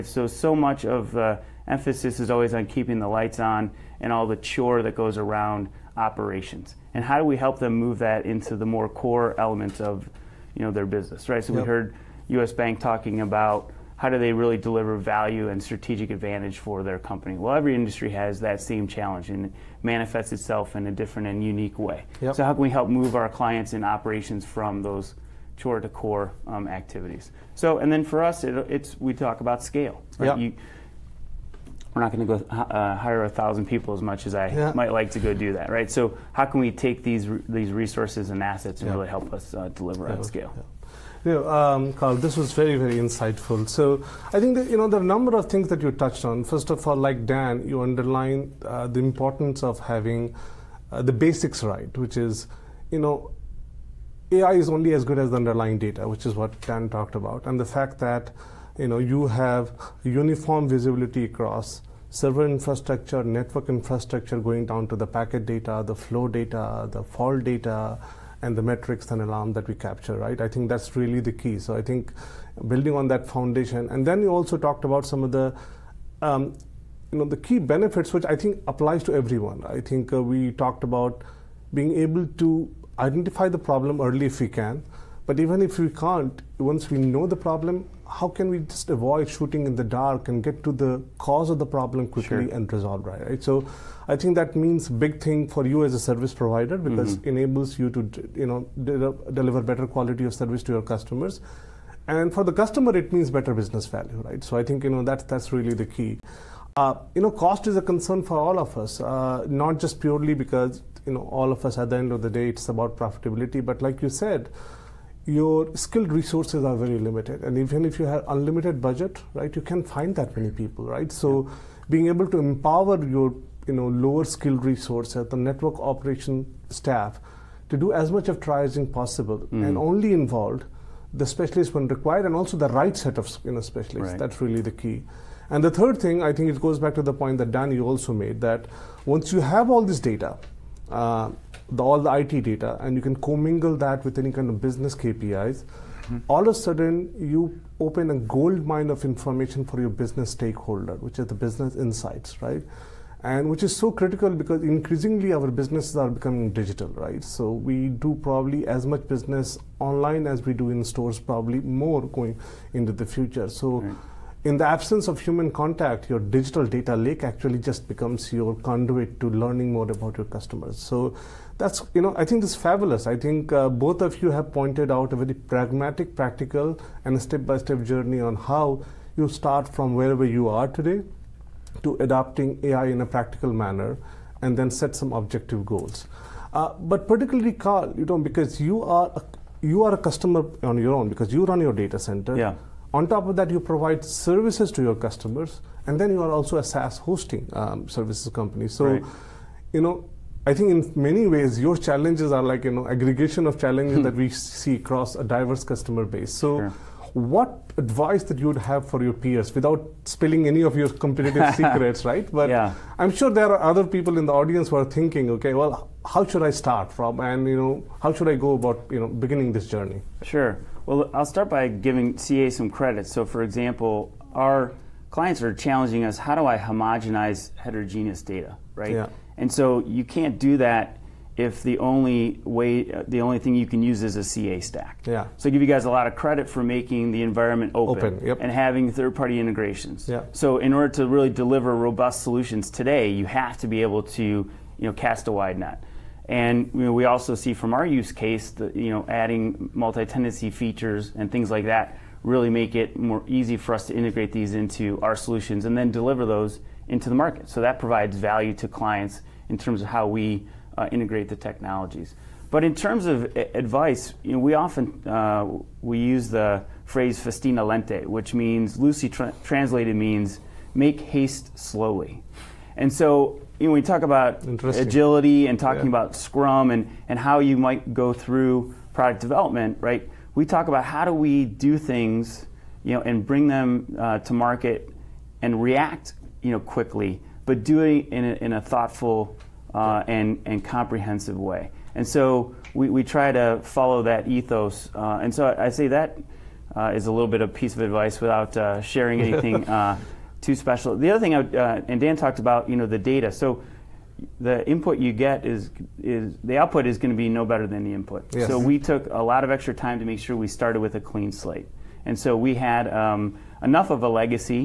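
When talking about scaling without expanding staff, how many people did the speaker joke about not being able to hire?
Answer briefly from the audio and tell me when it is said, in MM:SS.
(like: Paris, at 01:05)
1000, at 00:33.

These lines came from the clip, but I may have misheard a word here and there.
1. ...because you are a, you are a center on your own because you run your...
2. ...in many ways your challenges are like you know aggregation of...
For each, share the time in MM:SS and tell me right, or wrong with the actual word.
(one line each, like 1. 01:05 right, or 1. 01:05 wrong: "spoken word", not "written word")
1. 03:08 wrong: "customer", not "center"
2. 03:20 right.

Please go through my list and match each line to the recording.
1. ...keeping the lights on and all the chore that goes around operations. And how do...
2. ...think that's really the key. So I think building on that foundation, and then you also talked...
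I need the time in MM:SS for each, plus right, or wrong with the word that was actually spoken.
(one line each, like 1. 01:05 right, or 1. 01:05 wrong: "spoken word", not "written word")
1. 00:02 right
2. 01:10 right.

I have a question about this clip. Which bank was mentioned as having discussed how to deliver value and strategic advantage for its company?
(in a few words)
US Bank.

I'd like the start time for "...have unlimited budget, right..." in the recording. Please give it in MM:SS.
01:58.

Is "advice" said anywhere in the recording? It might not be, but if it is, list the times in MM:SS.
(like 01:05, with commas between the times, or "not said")
03:27, 04:23, 04:57.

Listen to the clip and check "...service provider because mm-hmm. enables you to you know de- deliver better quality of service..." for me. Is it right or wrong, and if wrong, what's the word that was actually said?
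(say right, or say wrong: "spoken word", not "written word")
right.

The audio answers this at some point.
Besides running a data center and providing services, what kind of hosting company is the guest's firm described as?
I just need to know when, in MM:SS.
03:16.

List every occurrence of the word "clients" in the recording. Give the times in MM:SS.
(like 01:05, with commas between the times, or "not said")
00:23, 03:45, 04:18.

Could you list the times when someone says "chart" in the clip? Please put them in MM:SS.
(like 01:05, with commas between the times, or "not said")
not said.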